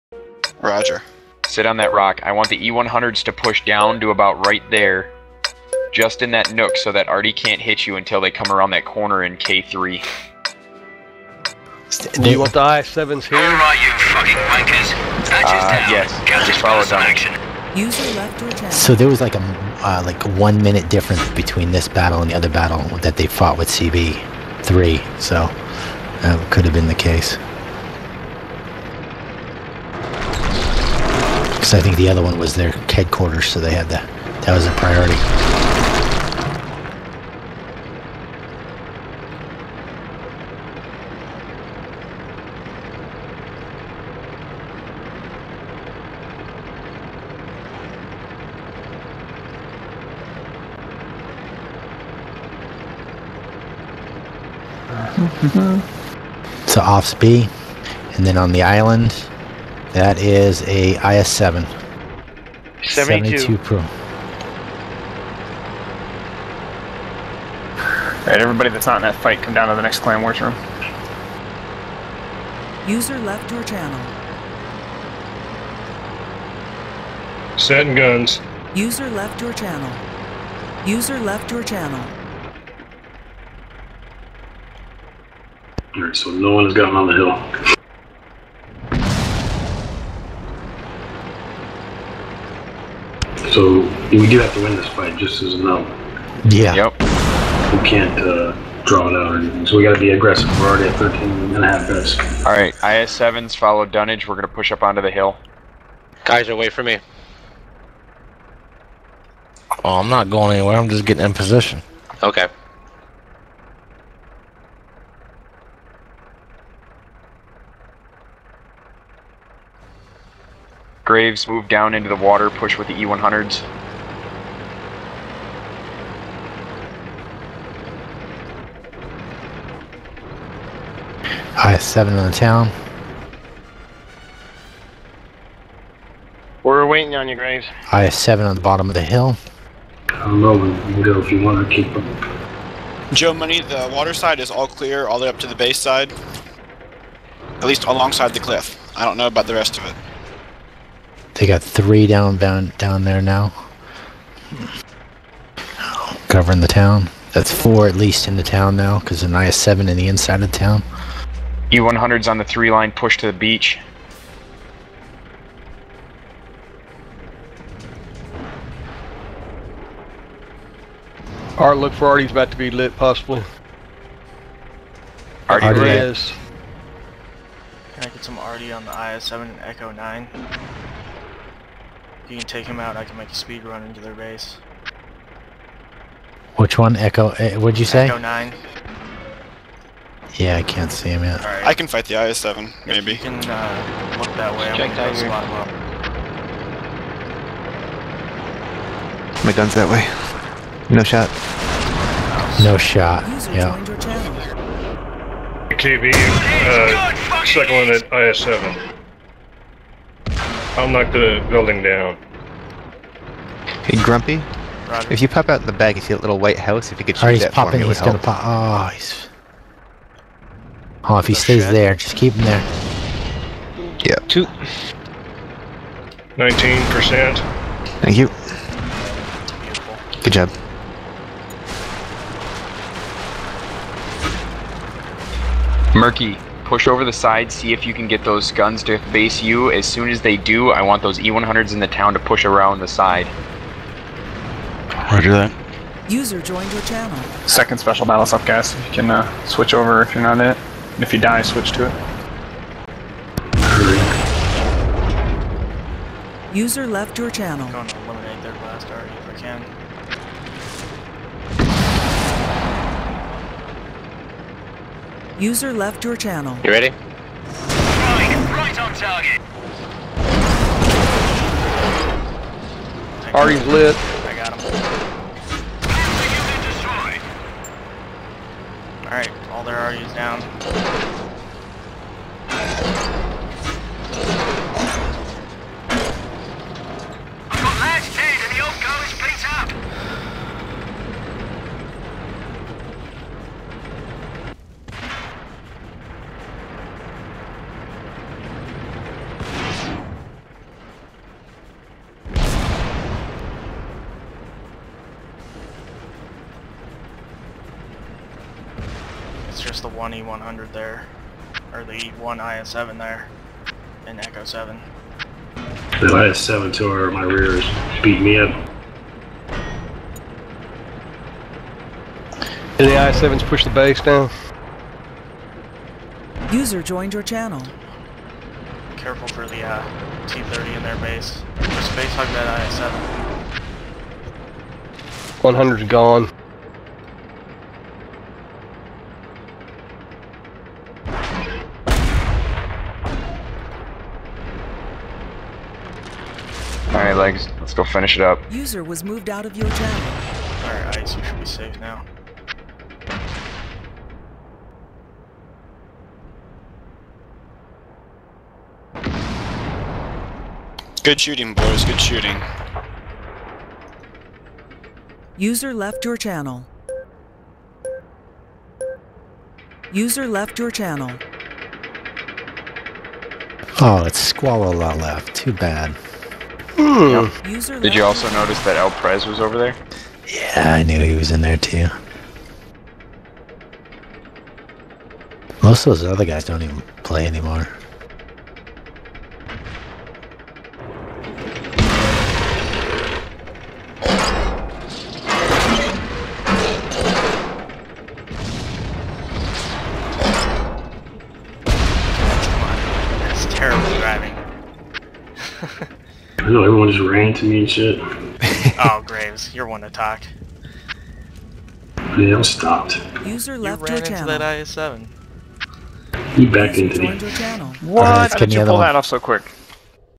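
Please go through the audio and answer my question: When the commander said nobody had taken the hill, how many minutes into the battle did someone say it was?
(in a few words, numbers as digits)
13 and a half.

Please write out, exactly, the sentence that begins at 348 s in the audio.
User was moved out of your channel.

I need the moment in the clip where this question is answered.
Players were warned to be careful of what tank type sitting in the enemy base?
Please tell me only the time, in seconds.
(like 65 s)
330 s.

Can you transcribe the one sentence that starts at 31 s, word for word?
I think the other one was their headquarters, so they had the that was a priority.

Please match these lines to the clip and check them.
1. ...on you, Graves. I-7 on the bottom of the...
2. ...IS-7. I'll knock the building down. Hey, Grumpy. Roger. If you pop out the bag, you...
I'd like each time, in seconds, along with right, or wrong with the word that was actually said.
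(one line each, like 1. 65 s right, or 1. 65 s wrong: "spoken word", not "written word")
1. 137 s right
2. 208 s right.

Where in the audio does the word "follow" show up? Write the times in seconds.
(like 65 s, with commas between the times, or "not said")
16 s, 103 s.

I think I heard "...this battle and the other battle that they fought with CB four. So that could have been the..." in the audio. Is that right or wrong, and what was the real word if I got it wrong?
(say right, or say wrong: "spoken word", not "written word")
wrong: "three", not "four".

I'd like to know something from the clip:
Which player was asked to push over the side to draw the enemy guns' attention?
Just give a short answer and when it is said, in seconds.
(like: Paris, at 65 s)
Murky, at 235 s.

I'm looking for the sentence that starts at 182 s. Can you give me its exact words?
you can take him out, I can make a speed run into their base.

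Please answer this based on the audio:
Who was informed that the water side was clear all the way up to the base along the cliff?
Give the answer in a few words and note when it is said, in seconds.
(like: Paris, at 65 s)
Joe Money, at 143 s.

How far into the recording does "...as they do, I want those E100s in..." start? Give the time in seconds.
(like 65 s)
240 s.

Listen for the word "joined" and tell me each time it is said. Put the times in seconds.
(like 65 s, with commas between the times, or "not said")
246 s, 326 s.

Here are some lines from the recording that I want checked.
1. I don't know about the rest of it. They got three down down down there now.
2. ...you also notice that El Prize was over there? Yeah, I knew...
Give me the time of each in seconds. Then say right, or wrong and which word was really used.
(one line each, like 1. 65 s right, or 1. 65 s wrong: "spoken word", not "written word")
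1. 148 s right
2. 377 s right.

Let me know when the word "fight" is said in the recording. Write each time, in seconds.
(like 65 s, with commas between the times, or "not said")
69 s, 94 s, 191 s.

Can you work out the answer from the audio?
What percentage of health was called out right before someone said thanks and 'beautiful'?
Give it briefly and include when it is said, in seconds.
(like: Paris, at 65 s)
19, at 226 s.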